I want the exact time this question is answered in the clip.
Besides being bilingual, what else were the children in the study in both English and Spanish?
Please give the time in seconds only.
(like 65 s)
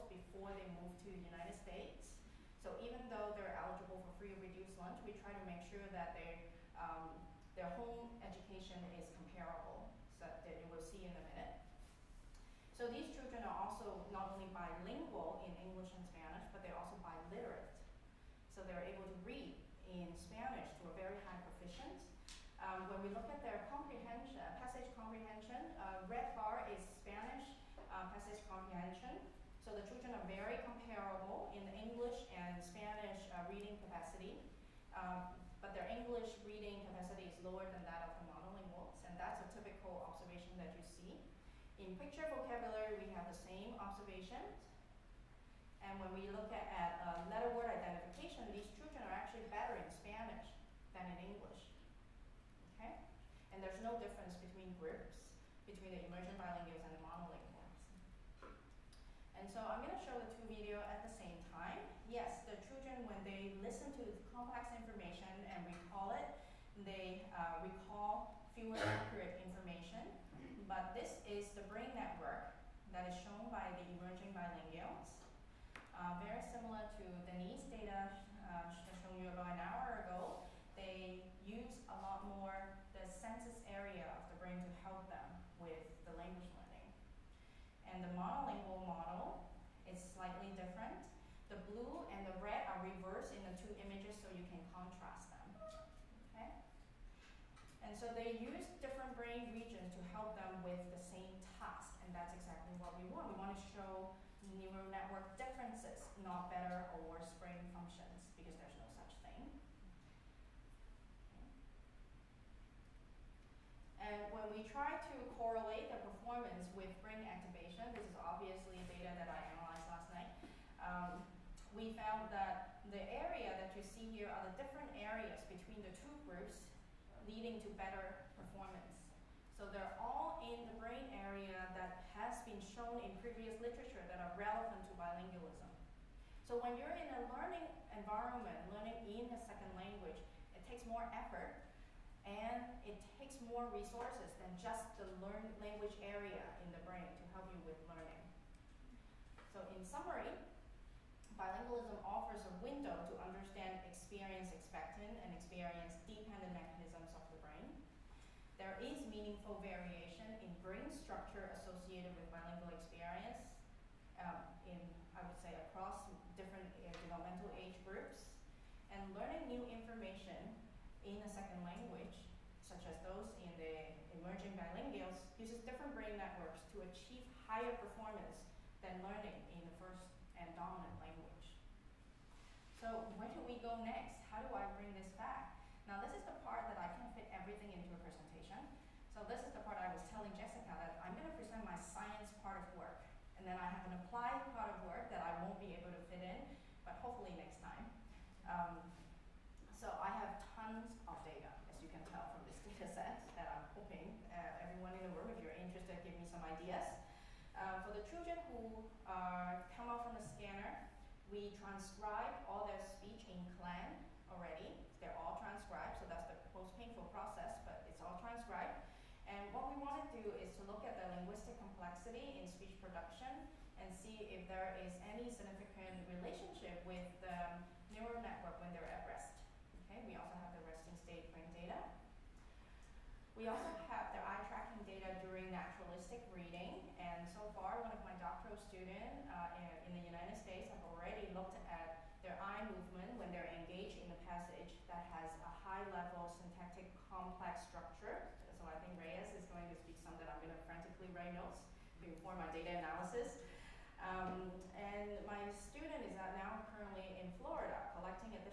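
17 s.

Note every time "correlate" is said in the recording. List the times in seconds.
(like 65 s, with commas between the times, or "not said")
115 s.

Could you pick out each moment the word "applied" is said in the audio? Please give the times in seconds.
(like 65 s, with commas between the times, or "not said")
194 s.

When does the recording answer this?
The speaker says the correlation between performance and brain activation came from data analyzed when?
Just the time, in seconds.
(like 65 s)
119 s.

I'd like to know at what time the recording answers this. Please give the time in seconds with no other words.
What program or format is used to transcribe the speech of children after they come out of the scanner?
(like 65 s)
213 s.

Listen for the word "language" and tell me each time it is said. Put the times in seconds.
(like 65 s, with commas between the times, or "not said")
139 s, 145 s, 171 s, 181 s.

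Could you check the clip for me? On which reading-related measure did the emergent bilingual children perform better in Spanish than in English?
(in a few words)
letter word identification.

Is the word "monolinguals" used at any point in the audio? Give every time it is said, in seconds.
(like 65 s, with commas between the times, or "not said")
38 s, 57 s.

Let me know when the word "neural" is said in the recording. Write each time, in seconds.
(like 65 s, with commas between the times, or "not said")
104 s, 227 s.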